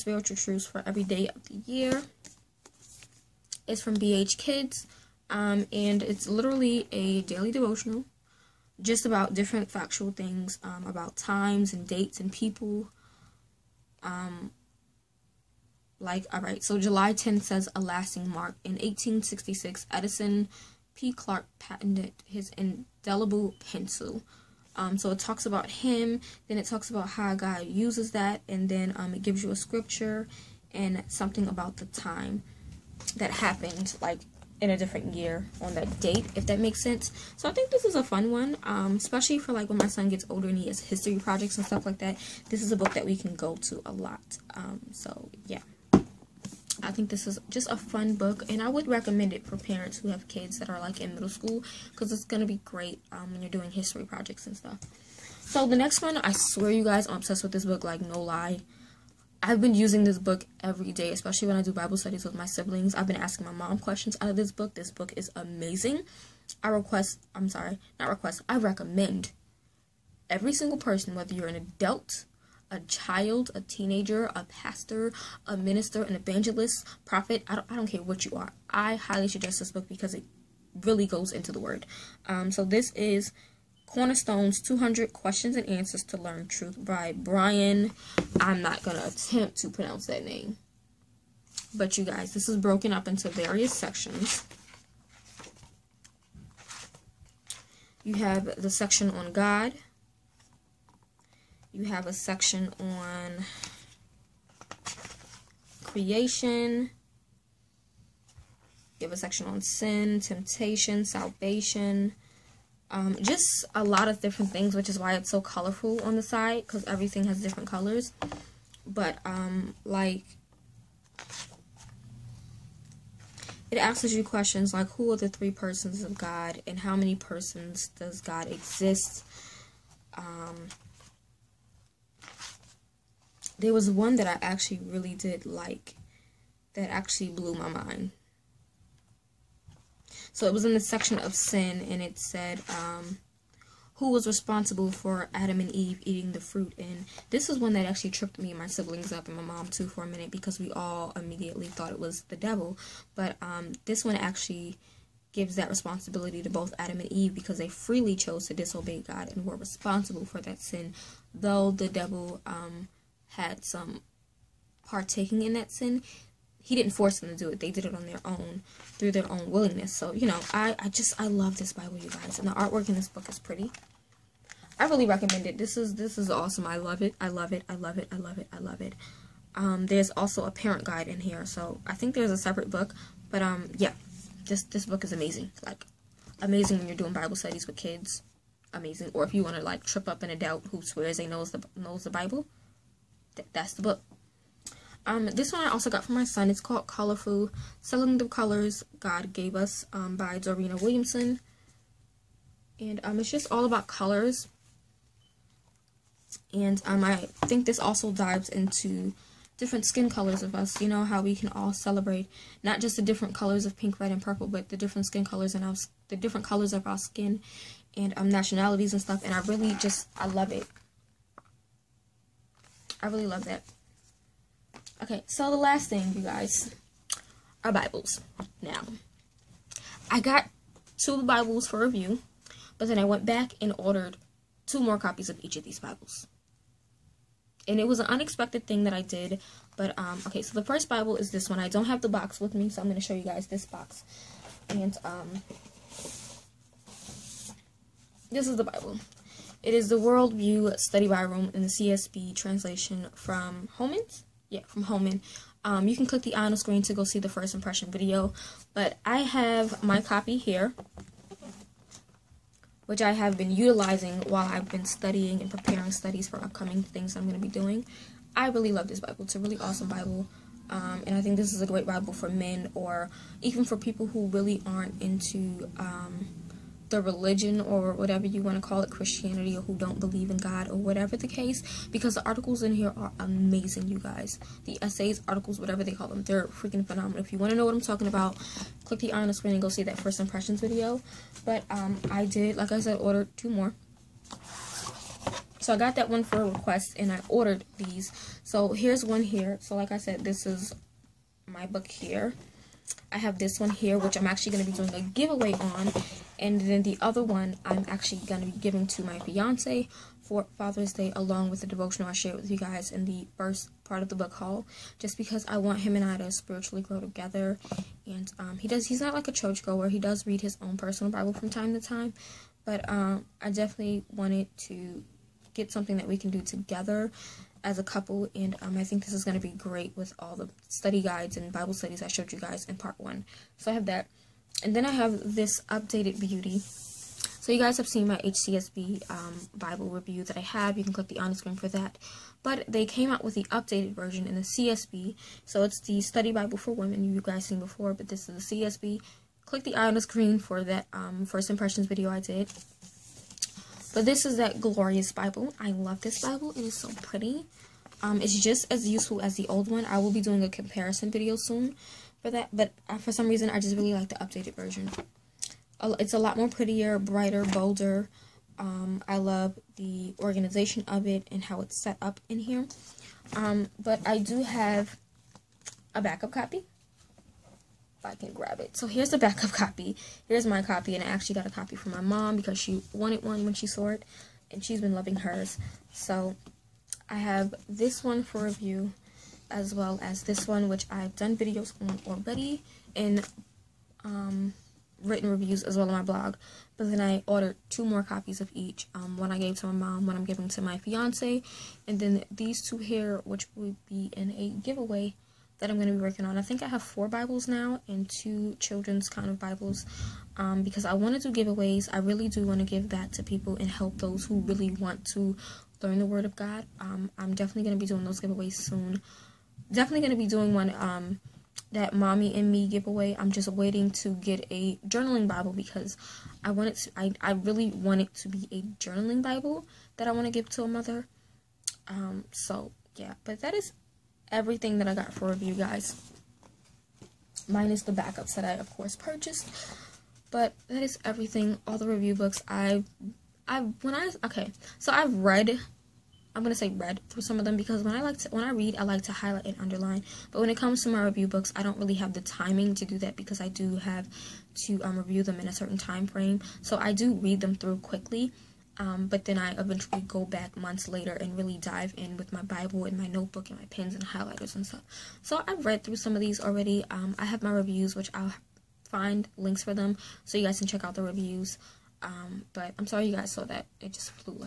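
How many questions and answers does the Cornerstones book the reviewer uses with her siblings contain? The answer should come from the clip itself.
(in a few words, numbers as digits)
200.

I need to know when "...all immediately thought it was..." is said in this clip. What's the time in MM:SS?
02:30.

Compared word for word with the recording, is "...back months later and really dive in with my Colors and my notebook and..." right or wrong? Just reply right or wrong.
wrong.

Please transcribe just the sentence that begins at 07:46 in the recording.
Um, I have my reviews, which I'll find links for them so you guys can check out the reviews.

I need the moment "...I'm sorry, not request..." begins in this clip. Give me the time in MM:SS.
01:07.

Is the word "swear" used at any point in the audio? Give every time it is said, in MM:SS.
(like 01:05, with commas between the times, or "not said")
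00:56, 03:10.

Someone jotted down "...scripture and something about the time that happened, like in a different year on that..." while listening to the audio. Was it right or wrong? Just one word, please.
right.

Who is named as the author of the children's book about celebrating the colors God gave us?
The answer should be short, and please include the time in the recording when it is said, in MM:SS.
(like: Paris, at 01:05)
Dorena Williamson, at 03:20.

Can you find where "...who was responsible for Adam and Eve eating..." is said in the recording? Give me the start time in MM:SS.
02:23.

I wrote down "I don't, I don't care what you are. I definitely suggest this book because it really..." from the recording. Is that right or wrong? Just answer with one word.
wrong.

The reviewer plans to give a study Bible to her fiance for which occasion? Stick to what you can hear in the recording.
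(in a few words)
Father's Day.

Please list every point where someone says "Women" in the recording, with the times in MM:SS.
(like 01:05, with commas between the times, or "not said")
05:46.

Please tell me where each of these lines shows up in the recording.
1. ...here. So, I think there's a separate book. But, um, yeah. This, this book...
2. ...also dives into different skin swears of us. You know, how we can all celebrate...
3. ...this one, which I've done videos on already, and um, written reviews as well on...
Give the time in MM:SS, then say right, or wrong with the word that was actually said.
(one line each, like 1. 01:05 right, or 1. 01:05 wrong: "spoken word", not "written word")
1. 03:01 right
2. 03:27 wrong: "colors", not "swears"
3. 06:30 right.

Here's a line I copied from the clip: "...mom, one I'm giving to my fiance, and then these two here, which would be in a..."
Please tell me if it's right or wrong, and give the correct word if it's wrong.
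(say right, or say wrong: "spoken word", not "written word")
right.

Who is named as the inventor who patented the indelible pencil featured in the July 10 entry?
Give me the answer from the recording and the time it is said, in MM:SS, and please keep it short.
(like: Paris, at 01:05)
Edison P. Clark, at 00:19.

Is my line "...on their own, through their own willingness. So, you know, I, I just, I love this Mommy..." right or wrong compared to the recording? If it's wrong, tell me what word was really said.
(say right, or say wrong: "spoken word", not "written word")
wrong: "Bible", not "Mommy".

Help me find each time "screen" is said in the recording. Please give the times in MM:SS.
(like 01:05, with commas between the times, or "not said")
04:16, 04:49, 05:41, 05:50.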